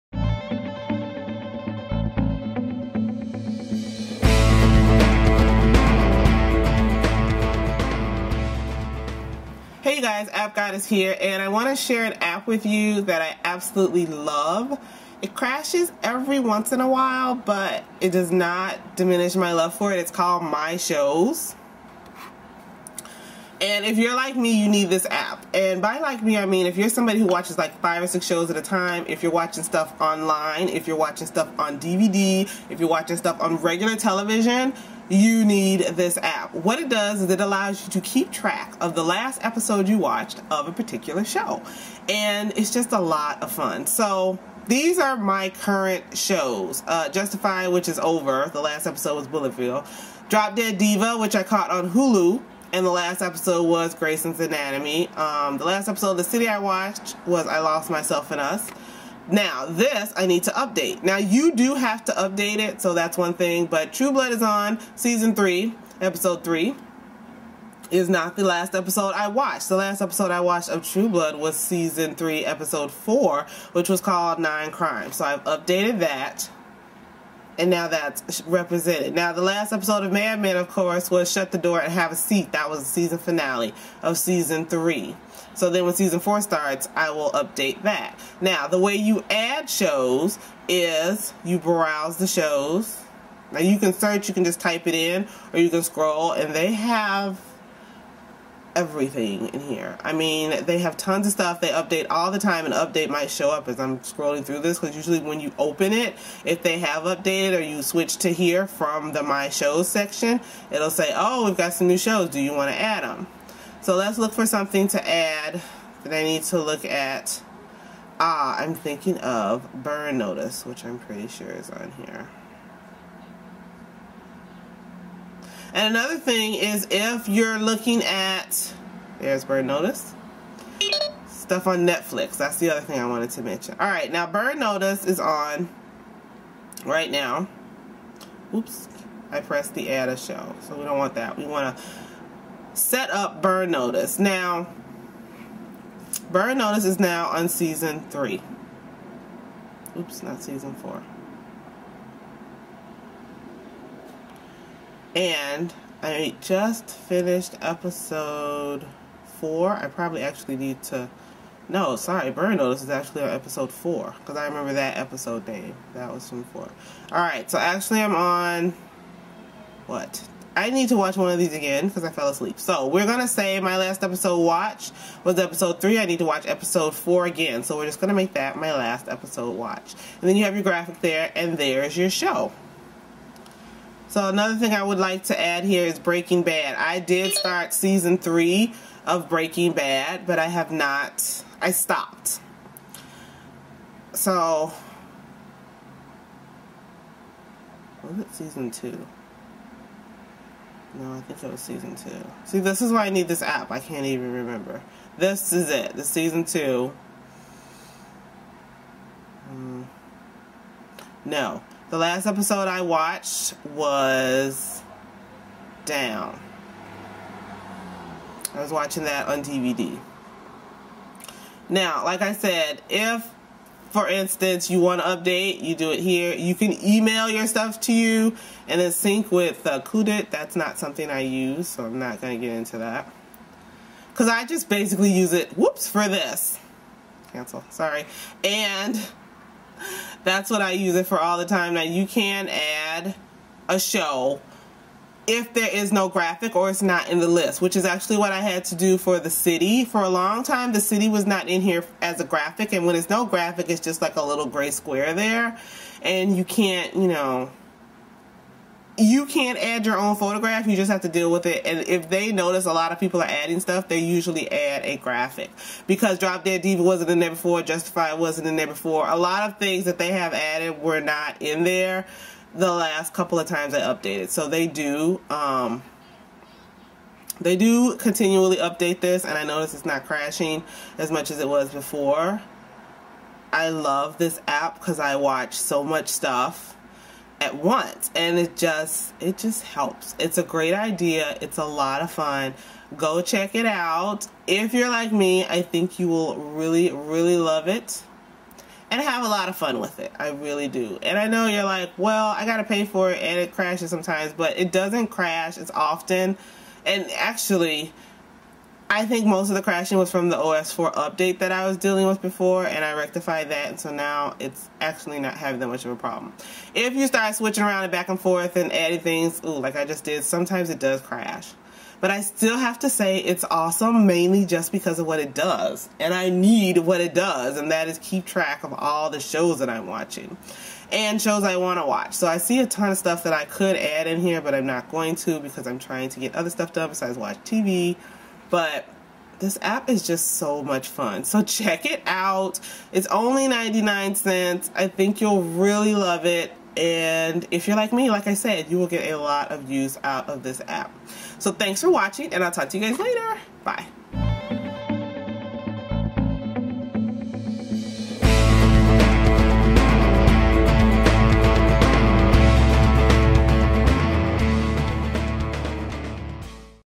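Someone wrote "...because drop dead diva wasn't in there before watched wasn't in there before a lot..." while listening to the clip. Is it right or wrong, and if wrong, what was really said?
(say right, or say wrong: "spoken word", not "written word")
wrong: "justified", not "watched".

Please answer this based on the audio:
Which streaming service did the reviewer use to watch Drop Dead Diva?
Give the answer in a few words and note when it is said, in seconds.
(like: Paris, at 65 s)
Hulu, at 51 s.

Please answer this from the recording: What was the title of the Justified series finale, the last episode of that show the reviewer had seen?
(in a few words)
Bulletville.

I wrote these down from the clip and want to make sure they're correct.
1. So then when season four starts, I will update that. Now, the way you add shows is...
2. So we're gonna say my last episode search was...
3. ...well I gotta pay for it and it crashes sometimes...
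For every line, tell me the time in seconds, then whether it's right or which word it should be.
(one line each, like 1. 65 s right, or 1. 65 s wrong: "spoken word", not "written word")
1. 85 s right
2. 172 s wrong: "watch", not "search"
3. 301 s right.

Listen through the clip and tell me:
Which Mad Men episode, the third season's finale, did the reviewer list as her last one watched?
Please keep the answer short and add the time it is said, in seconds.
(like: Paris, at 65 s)
Shut the Door and Have a Seat, at 81 s.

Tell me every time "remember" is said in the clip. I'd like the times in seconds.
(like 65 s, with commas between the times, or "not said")
164 s, 204 s.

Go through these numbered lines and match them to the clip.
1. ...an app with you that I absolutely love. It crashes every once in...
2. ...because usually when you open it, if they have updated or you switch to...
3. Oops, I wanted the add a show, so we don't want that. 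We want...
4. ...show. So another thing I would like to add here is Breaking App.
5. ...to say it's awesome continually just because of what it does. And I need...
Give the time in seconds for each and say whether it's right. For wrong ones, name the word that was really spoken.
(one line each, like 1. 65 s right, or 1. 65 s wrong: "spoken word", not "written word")
1. 12 s right
2. 104 s right
3. 138 s wrong: "pressed", not "wanted"
4. 182 s wrong: "Bad", not "App"
5. 322 s wrong: "mainly", not "continually".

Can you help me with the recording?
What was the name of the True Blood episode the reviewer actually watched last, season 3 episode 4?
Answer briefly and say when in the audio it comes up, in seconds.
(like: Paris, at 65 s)
Nine Crimes, at 74 s.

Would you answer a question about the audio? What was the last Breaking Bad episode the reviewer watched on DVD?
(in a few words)
Down.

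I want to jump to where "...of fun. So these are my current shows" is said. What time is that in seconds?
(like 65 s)
43 s.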